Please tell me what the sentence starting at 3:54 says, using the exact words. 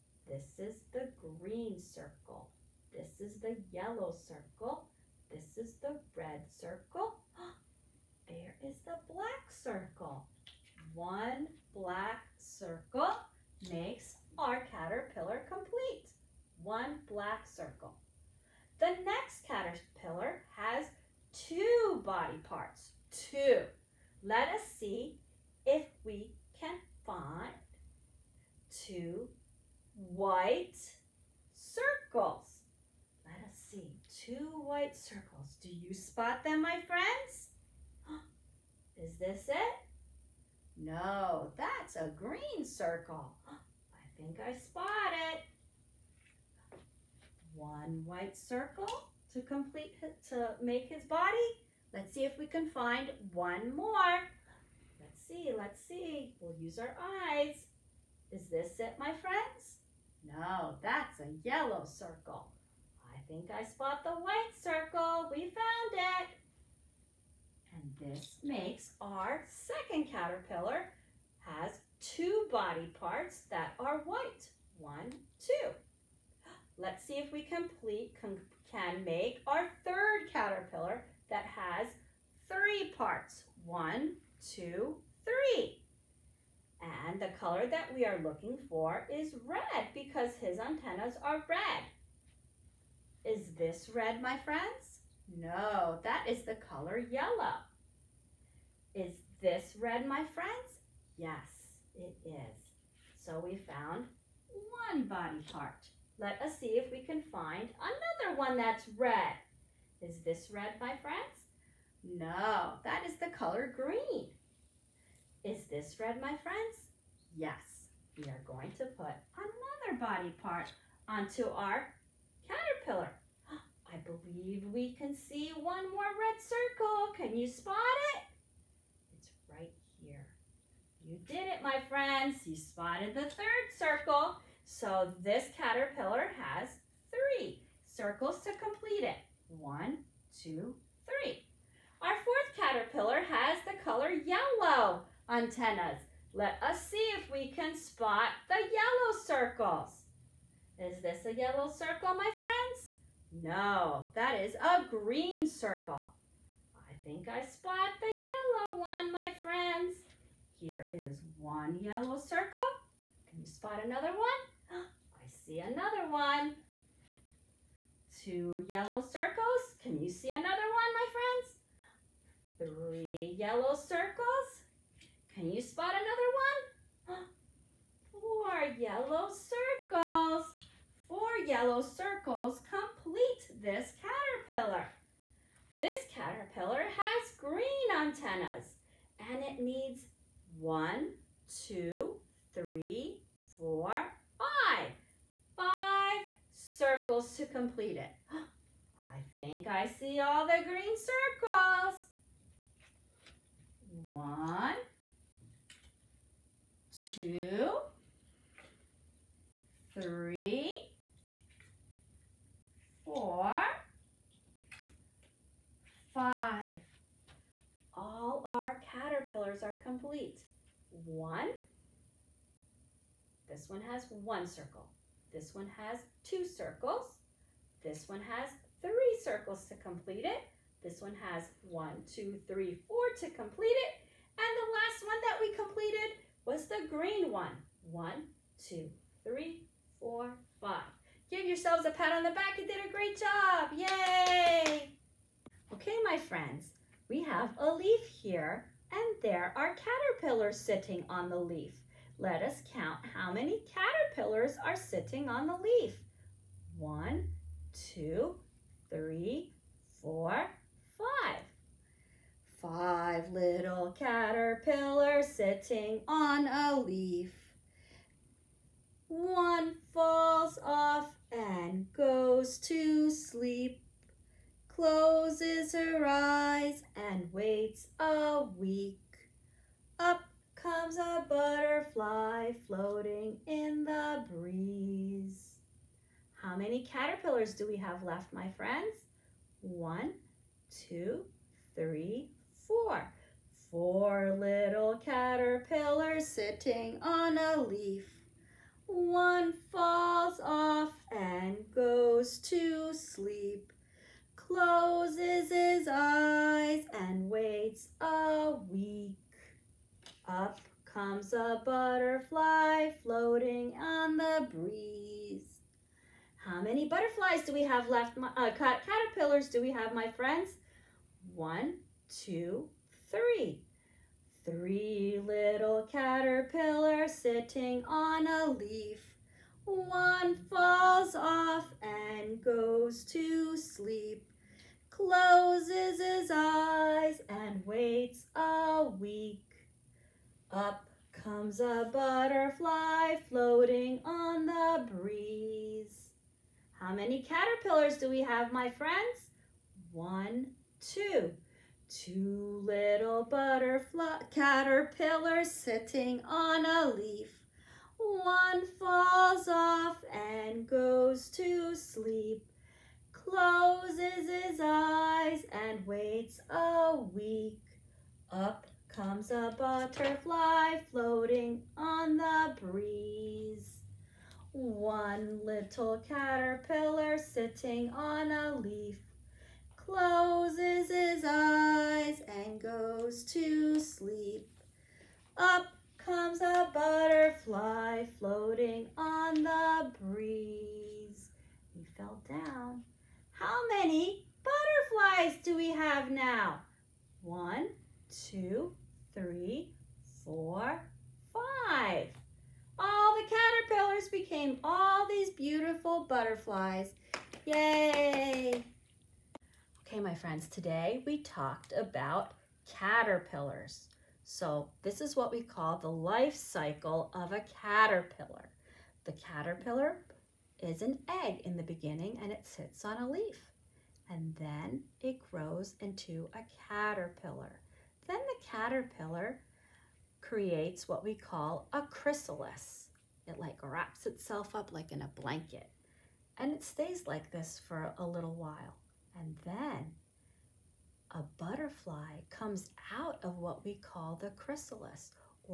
And the last one that we completed What's the green one?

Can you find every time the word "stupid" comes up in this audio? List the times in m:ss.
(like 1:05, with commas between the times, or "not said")
not said.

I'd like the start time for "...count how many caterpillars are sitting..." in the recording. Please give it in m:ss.
4:12.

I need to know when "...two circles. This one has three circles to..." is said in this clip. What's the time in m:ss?
3:46.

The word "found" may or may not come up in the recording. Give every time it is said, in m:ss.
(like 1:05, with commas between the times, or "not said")
1:05, 1:43.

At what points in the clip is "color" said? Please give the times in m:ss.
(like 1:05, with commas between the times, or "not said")
1:27, 1:36, 1:53, 2:23.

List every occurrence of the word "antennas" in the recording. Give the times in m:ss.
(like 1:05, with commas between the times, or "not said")
1:30, 2:25, 3:07.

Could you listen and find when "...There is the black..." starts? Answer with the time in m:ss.
0:08.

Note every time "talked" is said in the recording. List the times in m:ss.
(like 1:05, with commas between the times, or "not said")
6:51.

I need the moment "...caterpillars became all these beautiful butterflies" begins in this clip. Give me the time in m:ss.
6:43.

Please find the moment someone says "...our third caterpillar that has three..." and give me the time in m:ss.
1:19.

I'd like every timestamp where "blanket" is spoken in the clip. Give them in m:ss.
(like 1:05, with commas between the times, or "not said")
7:15.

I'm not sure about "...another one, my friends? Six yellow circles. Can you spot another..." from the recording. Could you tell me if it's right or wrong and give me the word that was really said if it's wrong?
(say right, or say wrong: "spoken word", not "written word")
wrong: "Three", not "Six".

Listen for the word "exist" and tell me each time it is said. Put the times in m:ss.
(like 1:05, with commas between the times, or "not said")
not said.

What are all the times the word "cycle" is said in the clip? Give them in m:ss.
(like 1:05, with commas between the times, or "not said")
6:56.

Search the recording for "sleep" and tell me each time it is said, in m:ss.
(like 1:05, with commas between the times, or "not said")
4:33, 5:02, 5:33, 6:01, 6:23.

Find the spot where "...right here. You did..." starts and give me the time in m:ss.
2:09.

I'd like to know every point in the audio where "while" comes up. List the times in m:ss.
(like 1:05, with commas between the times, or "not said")
7:18.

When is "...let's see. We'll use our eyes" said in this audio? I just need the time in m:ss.
0:55.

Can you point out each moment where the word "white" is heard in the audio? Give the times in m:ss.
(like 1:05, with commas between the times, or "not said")
0:29, 0:34, 0:48, 1:04, 1:14.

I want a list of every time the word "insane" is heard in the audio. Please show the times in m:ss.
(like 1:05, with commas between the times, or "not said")
not said.